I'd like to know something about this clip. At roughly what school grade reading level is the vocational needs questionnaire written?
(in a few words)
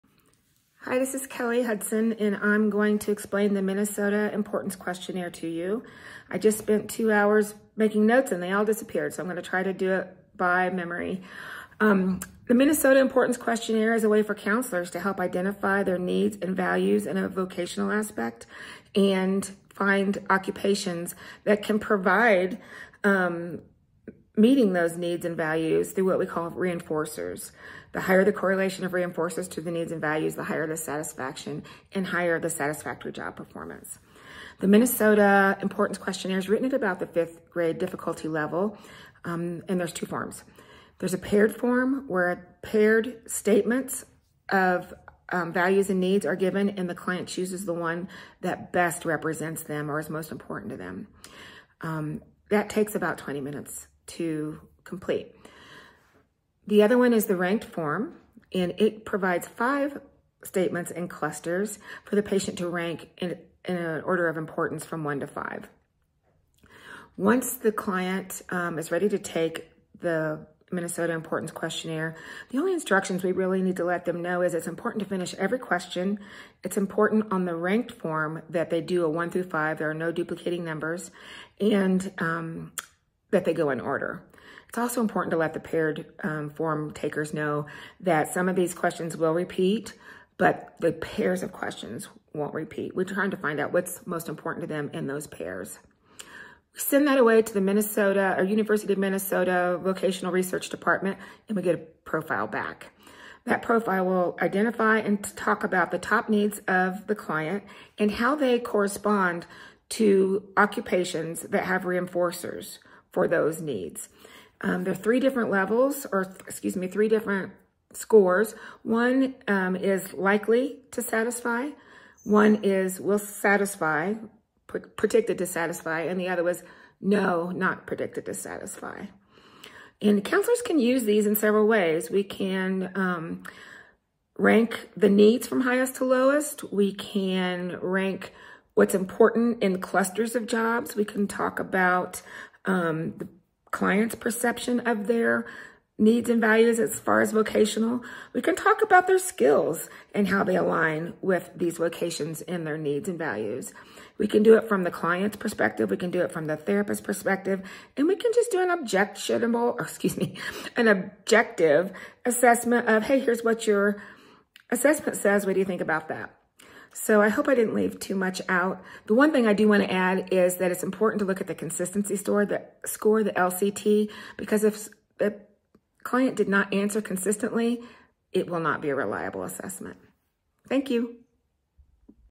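fifth grade.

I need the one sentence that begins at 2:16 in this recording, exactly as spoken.
We can rank what's important in clusters of jobs.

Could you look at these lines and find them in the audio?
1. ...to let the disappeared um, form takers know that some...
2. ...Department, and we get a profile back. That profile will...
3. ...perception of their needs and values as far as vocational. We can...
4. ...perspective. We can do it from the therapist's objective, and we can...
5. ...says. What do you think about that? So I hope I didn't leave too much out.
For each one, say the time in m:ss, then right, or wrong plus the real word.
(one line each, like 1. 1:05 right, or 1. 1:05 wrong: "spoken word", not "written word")
1. 1:25 wrong: "paired", not "disappeared"
2. 1:40 right
3. 2:24 right
4. 2:35 wrong: "perspective", not "objective"
5. 2:45 right.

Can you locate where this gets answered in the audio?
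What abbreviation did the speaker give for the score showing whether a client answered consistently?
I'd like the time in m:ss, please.
2:53.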